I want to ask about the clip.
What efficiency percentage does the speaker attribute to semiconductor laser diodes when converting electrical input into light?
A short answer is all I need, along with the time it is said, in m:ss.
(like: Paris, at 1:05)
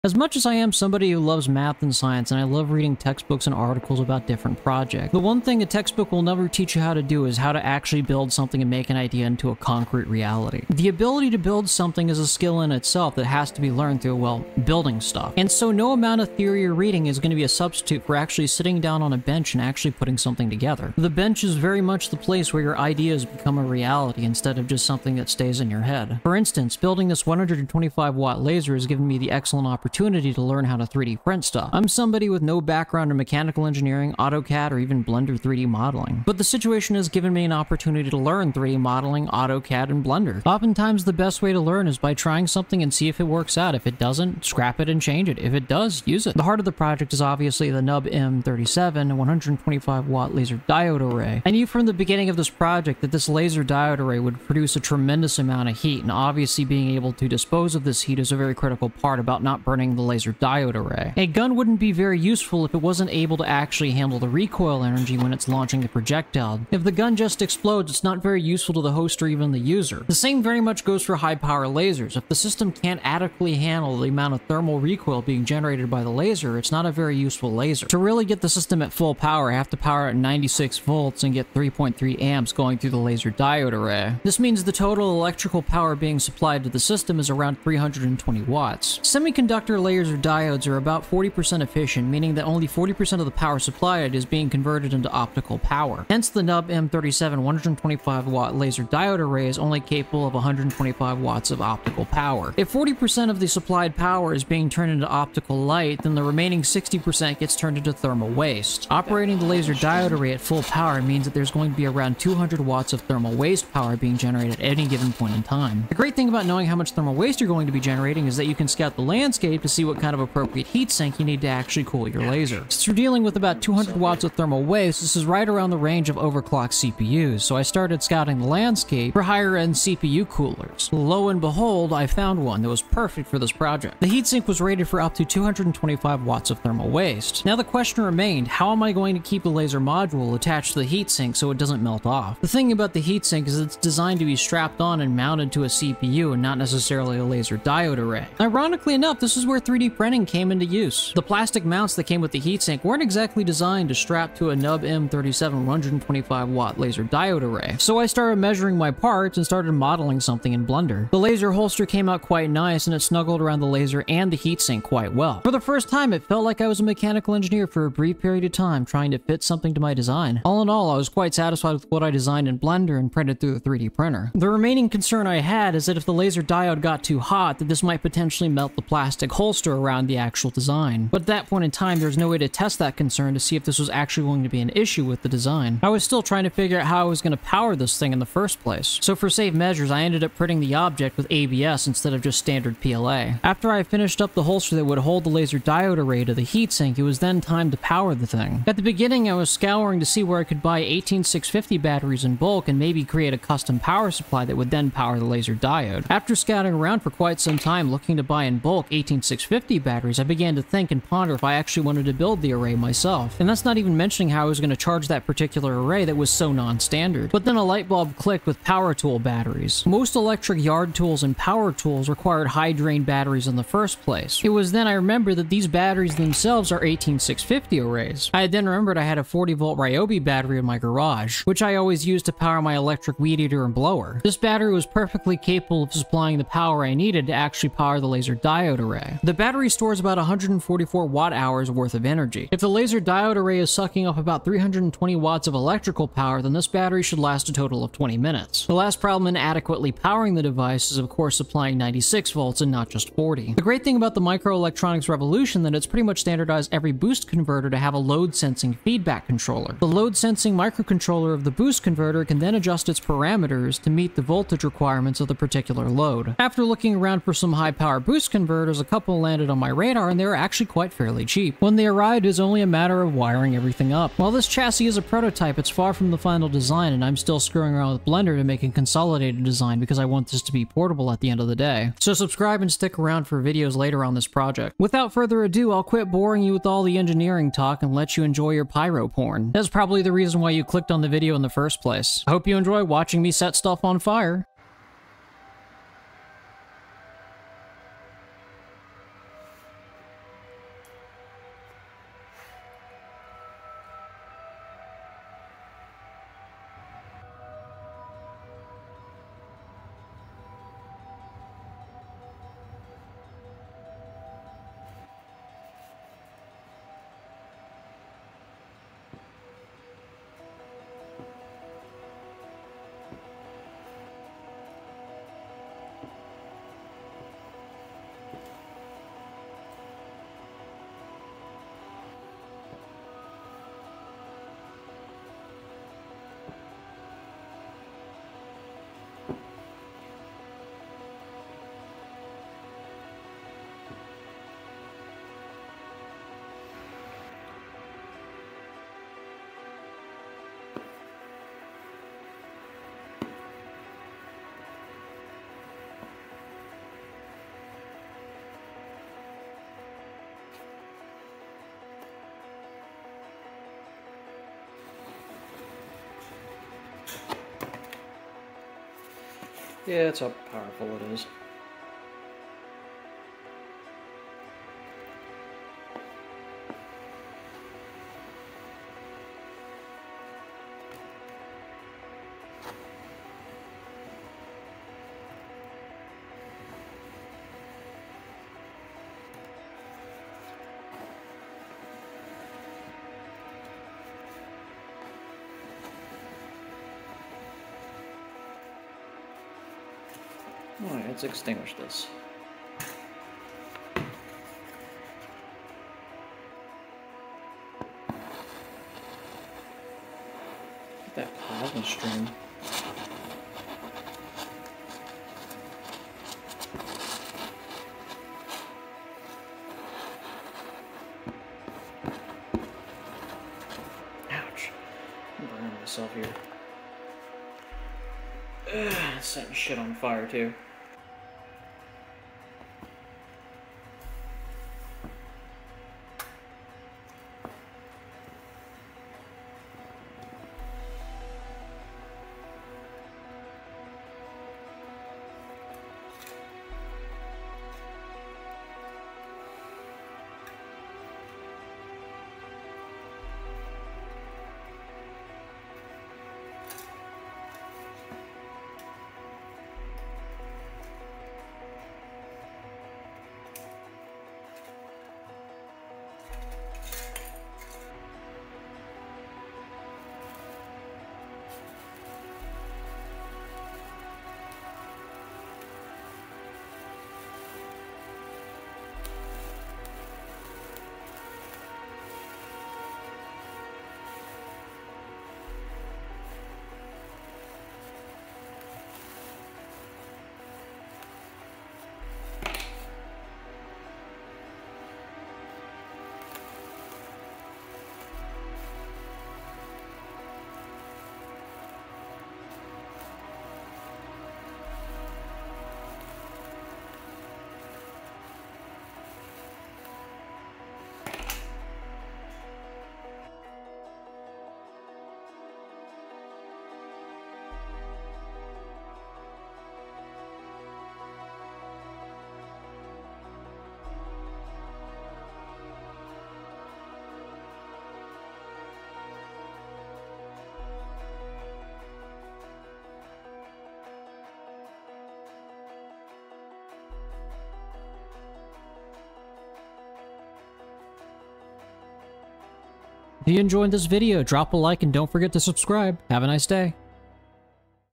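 40%, at 1:31.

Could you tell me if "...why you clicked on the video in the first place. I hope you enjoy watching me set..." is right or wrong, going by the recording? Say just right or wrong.
right.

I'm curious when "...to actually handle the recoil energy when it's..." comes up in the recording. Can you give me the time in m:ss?
1:03.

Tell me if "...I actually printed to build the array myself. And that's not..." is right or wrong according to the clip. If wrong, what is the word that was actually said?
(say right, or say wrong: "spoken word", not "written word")
wrong: "wanted", not "printed".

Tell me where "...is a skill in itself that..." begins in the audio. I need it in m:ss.
0:12.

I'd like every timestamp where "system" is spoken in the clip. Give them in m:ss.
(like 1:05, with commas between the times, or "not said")
1:12, 1:18, 1:26.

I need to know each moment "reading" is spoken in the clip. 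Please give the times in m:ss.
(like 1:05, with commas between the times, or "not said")
0:02, 0:16.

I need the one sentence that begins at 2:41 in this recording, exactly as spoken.
The laser holster came out quite nice and it snuggled around the laser and the heatsink quite well.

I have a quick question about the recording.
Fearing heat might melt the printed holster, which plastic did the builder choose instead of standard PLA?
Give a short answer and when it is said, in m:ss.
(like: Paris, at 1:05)
ABS, at 3:11.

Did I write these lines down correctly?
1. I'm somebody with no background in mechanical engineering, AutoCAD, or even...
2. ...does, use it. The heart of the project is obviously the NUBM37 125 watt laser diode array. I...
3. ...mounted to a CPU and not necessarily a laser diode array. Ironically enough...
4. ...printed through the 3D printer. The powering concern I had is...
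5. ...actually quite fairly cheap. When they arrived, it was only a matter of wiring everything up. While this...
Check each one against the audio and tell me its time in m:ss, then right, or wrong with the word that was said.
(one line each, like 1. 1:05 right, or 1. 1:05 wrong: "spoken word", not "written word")
1. 0:31 right
2. 0:45 right
3. 2:25 right
4. 2:53 wrong: "remaining", not "powering"
5. 4:30 right.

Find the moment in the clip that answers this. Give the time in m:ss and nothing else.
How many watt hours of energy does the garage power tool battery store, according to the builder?
4:00.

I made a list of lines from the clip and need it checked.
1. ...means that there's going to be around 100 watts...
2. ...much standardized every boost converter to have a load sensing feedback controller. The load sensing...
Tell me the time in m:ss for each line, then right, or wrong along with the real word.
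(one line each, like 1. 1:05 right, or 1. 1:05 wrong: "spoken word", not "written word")
1. 1:51 wrong: "200", not "100"
2. 4:16 right.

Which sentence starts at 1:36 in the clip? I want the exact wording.
Hence the NUBM37 125 watt laser diode array is only capable of 125 watts of optical power.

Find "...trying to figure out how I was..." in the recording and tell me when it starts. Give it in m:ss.
3:06.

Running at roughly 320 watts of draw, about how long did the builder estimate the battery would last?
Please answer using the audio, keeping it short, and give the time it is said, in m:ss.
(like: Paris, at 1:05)
20 minutes, at 4:07.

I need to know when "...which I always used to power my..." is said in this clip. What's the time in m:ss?
3:51.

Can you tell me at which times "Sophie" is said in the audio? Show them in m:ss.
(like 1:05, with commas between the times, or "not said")
not said.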